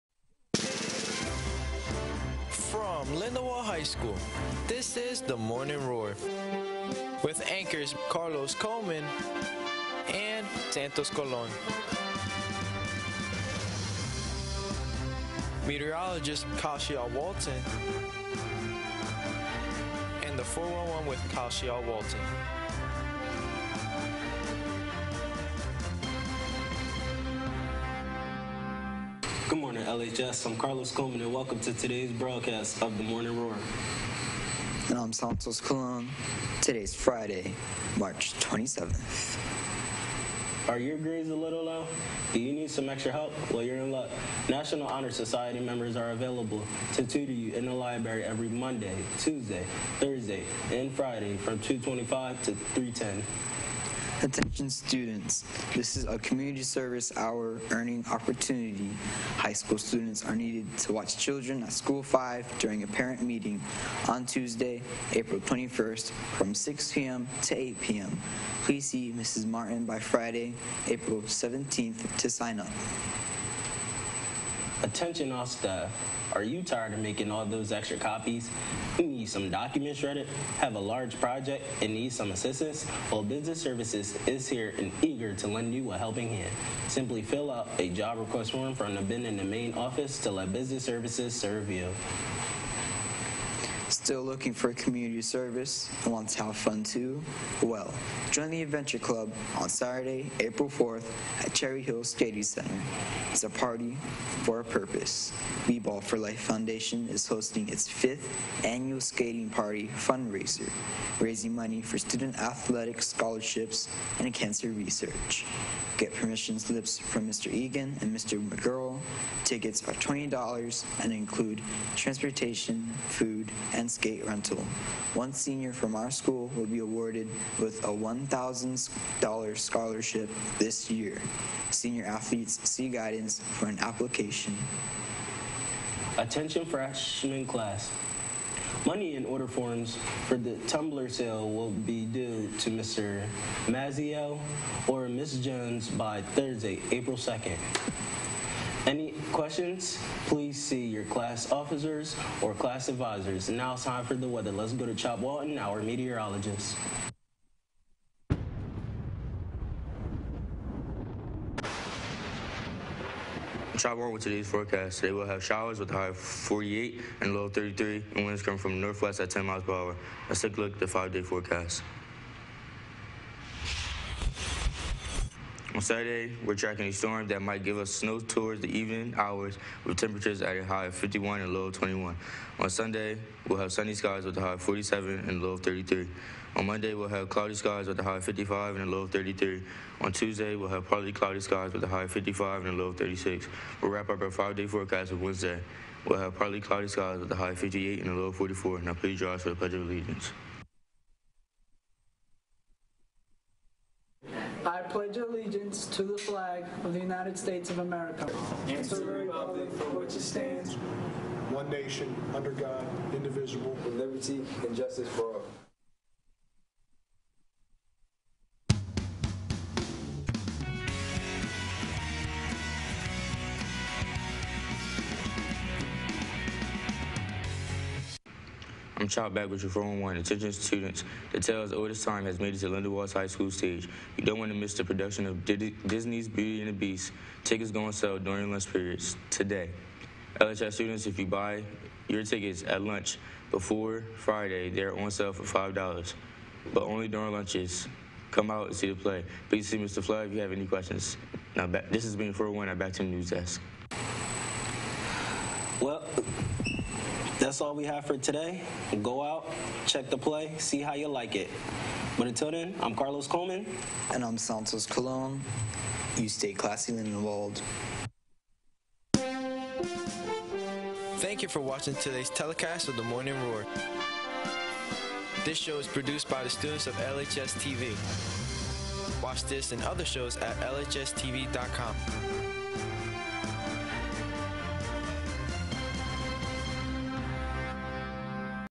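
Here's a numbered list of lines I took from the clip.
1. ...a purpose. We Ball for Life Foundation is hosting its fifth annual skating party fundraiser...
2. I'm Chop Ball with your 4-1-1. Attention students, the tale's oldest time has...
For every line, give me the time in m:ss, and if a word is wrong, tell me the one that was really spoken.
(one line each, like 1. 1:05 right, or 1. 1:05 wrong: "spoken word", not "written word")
1. 1:44 right
2. 3:49 wrong: "Back", not "Ball".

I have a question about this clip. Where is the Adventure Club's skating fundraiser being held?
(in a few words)
Cherry Hill Skating Center.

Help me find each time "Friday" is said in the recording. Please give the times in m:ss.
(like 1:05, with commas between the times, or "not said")
0:36, 0:50, 1:09, 4:04.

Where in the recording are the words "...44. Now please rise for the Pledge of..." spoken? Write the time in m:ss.
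3:18.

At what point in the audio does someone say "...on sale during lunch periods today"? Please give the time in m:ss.
3:57.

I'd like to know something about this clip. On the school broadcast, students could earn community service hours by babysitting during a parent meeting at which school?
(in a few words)
School 5.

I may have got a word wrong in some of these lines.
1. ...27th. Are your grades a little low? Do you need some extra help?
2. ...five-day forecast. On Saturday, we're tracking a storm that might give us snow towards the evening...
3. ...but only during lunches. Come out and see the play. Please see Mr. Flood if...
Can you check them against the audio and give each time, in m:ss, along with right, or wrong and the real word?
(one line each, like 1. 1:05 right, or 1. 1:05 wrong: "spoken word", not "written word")
1. 0:38 right
2. 2:50 right
3. 4:06 right.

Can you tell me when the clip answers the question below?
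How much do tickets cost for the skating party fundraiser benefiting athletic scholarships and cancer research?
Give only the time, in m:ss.
1:59.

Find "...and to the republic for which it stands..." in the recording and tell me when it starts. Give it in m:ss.
3:28.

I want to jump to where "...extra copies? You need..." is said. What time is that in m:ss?
1:17.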